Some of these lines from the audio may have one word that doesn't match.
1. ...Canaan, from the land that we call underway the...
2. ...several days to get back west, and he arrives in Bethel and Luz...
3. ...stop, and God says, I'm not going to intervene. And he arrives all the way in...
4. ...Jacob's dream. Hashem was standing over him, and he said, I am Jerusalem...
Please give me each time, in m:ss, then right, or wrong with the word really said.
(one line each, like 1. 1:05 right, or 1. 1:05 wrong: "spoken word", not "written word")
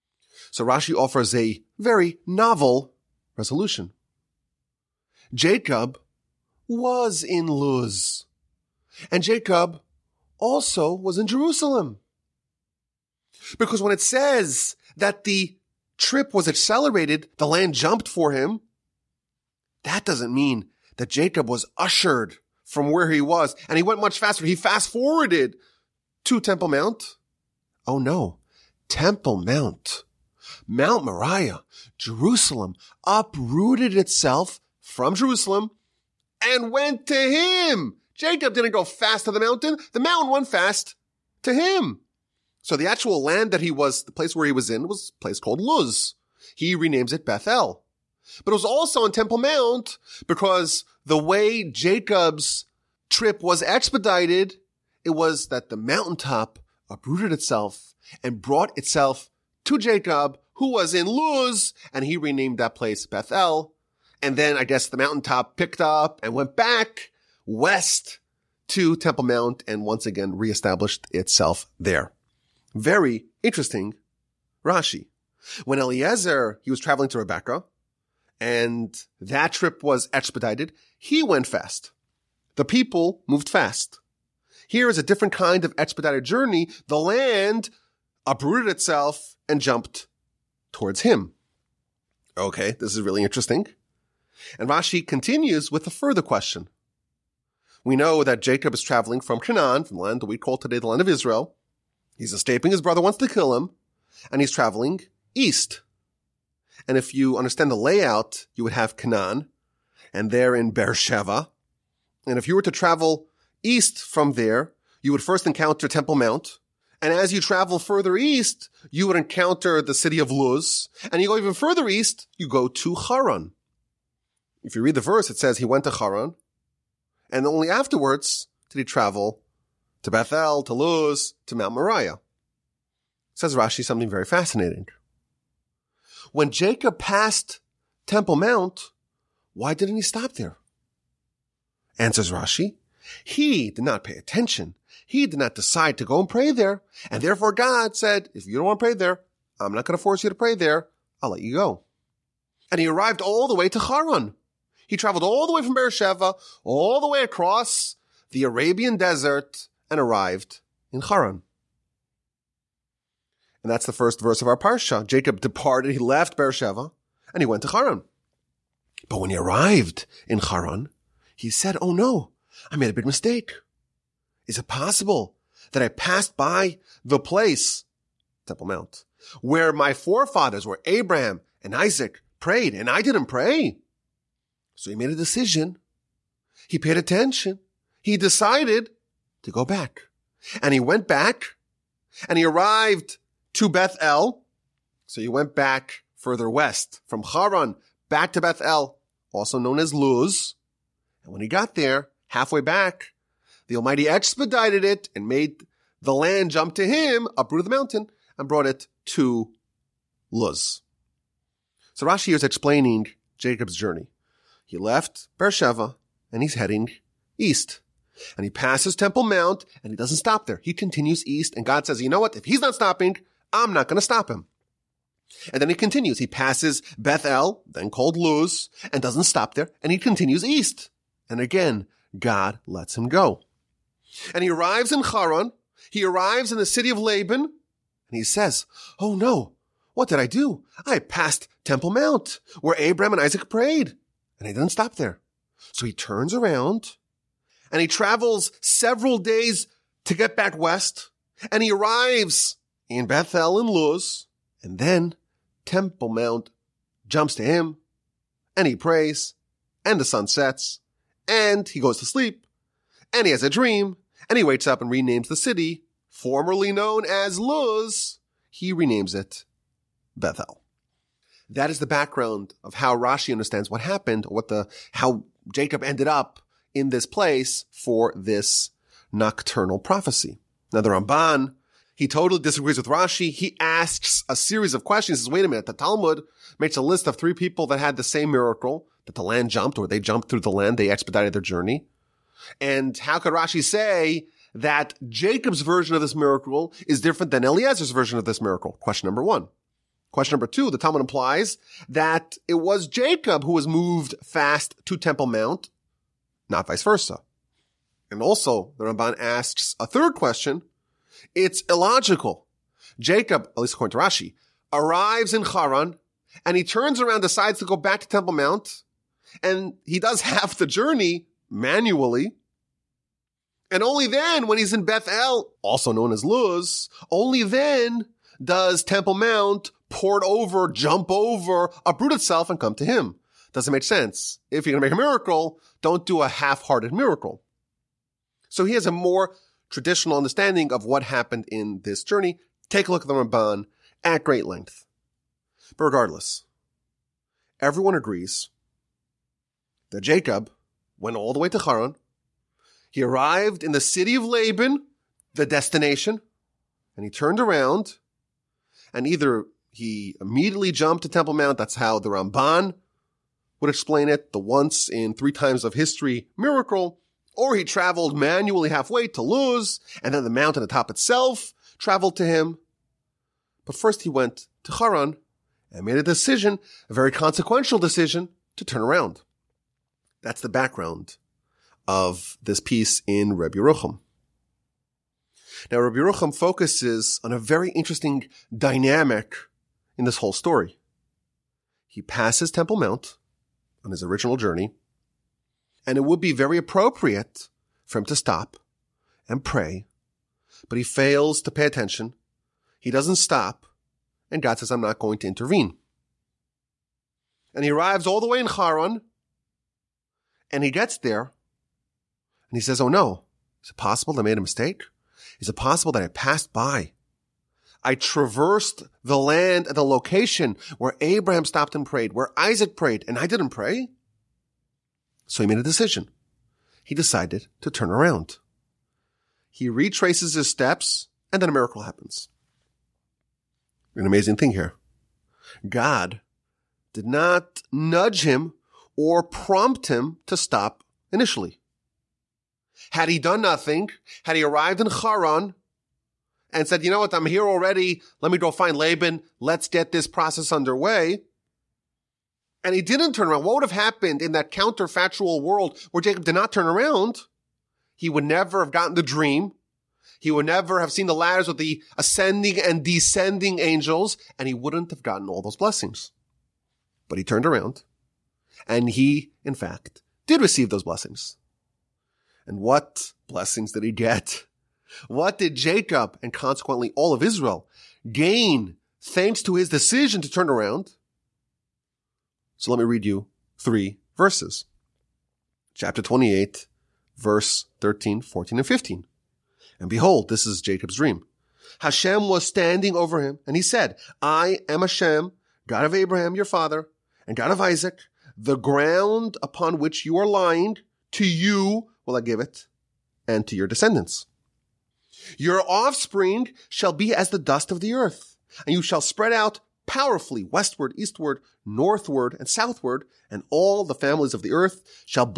1. 1:39 wrong: "today", not "underway"
2. 4:08 right
3. 6:43 right
4. 8:10 wrong: "Hashem", not "Jerusalem".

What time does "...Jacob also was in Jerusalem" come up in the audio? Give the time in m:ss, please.
0:09.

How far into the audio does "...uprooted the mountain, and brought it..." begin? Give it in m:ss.
3:27.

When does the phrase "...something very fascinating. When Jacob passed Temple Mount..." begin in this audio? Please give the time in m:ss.
2:13.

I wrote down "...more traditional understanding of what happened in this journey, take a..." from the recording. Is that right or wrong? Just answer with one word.
right.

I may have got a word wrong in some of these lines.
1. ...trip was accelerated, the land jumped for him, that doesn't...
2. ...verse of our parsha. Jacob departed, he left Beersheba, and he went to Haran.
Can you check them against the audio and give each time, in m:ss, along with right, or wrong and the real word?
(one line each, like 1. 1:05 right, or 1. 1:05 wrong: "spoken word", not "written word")
1. 0:15 right
2. 2:44 right.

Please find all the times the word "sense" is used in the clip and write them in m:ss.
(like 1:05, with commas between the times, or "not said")
5:33.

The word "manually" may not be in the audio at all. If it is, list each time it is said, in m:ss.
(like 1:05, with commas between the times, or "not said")
5:21, 6:08.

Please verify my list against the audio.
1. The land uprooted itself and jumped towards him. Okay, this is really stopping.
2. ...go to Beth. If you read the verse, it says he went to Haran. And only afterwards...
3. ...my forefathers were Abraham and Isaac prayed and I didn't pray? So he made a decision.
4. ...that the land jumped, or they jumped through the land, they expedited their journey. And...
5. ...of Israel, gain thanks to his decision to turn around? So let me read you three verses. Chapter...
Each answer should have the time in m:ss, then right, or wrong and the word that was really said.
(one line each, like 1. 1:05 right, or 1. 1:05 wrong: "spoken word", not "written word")
1. 1:26 wrong: "interesting", not "stopping"
2. 2:02 wrong: "Haran", not "Beth"
3. 2:59 right
4. 4:49 right
5. 7:57 right.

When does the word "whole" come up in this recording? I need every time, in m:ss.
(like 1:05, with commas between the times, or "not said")
6:30.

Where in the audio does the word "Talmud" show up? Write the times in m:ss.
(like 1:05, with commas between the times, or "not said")
4:45, 5:00.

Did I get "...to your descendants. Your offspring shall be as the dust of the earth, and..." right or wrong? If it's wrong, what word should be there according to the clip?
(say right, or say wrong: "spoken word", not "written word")
right.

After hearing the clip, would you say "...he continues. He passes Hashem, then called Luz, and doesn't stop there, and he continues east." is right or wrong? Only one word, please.
wrong.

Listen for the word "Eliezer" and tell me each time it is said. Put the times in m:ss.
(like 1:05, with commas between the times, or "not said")
1:15, 4:57.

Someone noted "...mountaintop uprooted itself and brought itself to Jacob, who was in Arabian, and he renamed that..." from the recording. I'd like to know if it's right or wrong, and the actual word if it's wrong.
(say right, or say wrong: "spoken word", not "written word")
wrong: "Luz", not "Arabian".